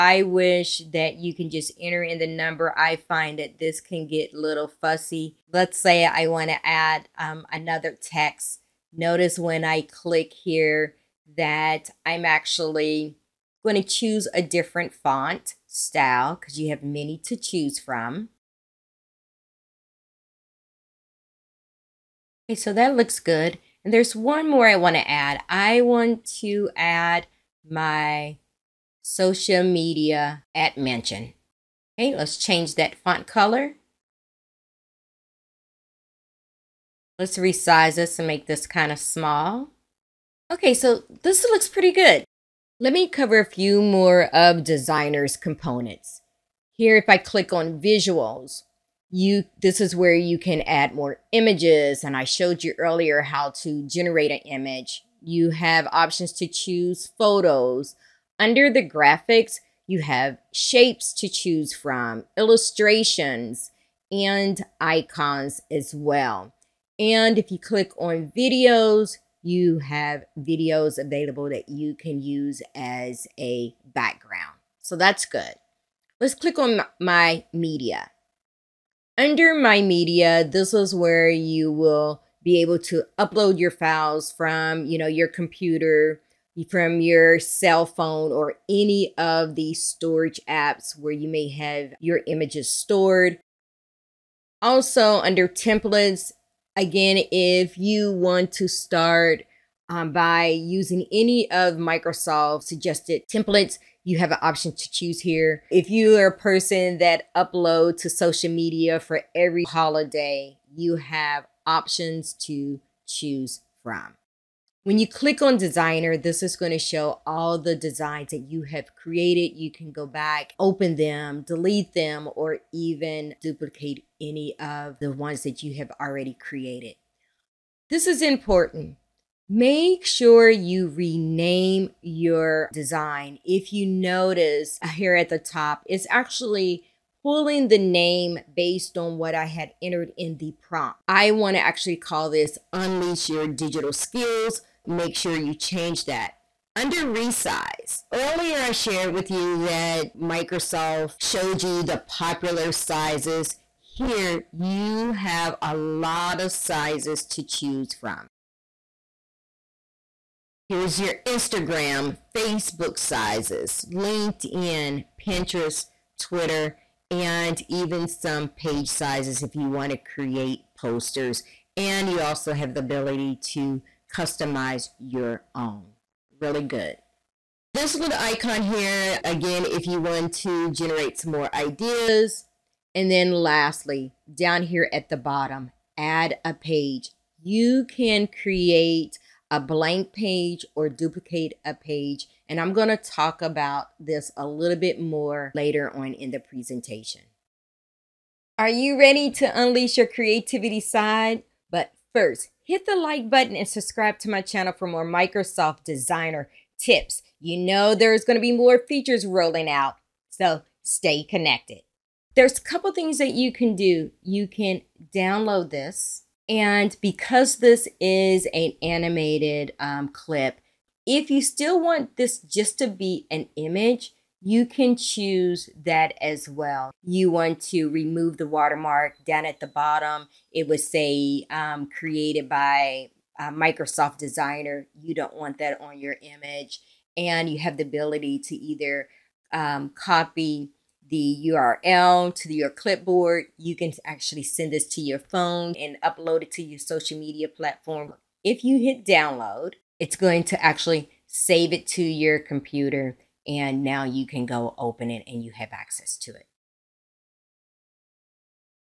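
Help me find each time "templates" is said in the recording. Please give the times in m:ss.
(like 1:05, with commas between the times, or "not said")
1:35, 1:43.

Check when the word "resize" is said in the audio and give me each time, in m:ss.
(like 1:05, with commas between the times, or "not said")
0:37, 2:27.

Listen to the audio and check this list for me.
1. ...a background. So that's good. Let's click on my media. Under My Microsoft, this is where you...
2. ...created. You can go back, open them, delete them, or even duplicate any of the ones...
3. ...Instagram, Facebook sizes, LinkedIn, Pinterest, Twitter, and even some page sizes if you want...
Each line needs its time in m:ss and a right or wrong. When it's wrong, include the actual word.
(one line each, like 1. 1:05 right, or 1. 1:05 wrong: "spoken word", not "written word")
1. 1:13 wrong: "Media", not "Microsoft"
2. 1:59 right
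3. 2:41 right.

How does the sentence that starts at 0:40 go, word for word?
Okay, so this looks pretty good.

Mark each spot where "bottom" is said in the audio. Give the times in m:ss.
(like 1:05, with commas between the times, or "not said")
3:05, 3:49.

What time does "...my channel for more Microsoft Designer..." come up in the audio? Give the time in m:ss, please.
3:24.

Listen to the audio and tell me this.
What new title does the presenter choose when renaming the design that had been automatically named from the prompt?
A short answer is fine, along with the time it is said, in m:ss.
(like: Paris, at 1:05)
Unleash Your Digital Skills, at 2:22.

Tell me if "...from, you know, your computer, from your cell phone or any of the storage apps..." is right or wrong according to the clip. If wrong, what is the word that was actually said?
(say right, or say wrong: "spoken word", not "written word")
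right.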